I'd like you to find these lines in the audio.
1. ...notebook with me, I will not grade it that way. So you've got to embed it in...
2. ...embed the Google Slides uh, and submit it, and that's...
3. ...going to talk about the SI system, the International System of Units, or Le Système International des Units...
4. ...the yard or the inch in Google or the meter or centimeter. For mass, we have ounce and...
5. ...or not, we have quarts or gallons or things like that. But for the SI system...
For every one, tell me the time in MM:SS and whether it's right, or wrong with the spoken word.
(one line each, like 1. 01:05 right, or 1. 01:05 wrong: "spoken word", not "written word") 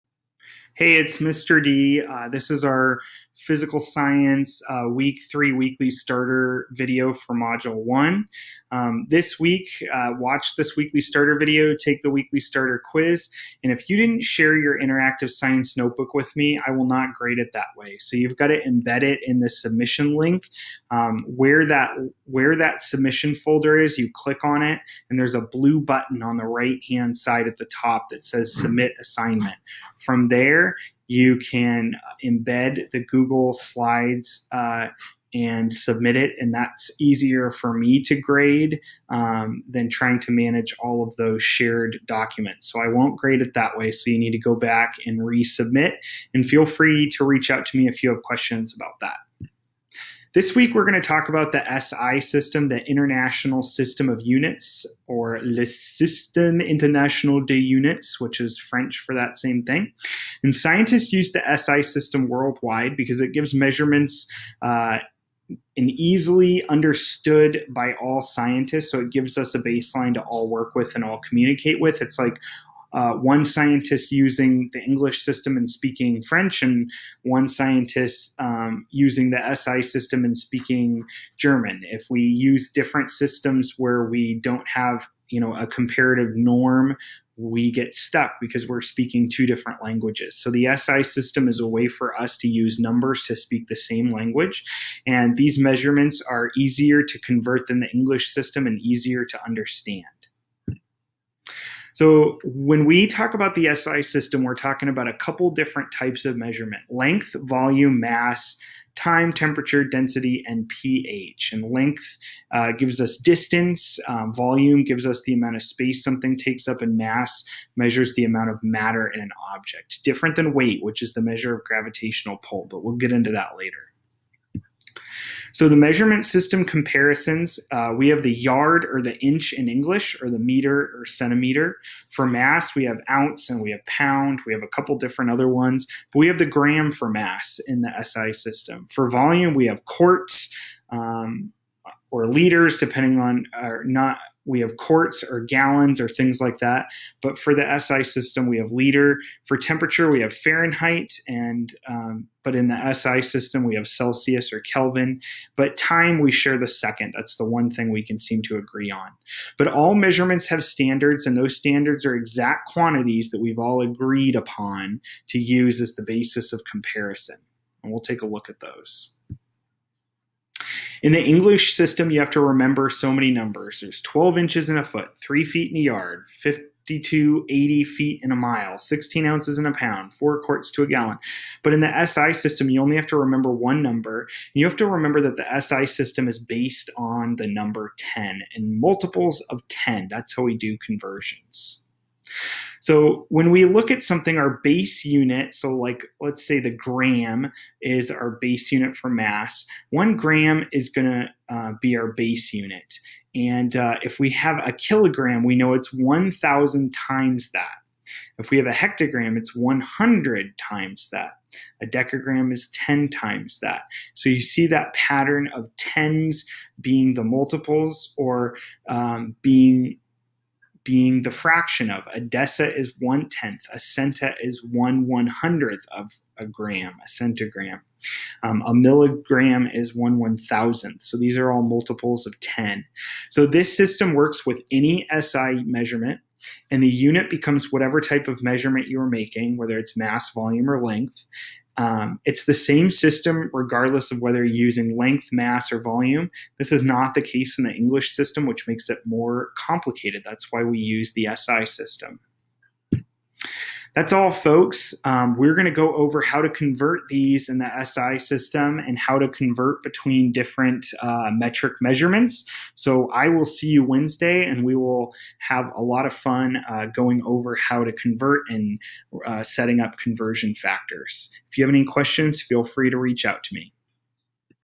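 1. 00:15 right
2. 00:32 right
3. 00:50 right
4. 02:08 wrong: "English", not "Google"
5. 02:23 right.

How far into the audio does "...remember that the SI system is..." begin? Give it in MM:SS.
03:04.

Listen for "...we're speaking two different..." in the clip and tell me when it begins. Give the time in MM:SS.
01:28.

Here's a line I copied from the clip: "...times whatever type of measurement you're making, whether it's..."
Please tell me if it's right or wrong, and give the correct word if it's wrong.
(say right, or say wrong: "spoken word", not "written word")
wrong: "becomes", not "times".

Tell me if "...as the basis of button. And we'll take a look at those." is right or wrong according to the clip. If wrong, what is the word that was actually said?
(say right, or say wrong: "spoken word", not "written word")
wrong: "comparison", not "button".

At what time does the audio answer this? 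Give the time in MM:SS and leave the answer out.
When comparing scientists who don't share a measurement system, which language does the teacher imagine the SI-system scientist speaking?
01:21.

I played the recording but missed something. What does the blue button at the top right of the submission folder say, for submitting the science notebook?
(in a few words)
Submit assignment.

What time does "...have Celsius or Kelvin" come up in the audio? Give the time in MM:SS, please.
02:33.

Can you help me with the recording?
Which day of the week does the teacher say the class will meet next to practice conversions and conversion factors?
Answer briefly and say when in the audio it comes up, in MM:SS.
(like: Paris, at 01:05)
Wednesday, at 04:23.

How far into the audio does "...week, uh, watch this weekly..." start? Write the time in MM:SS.
00:09.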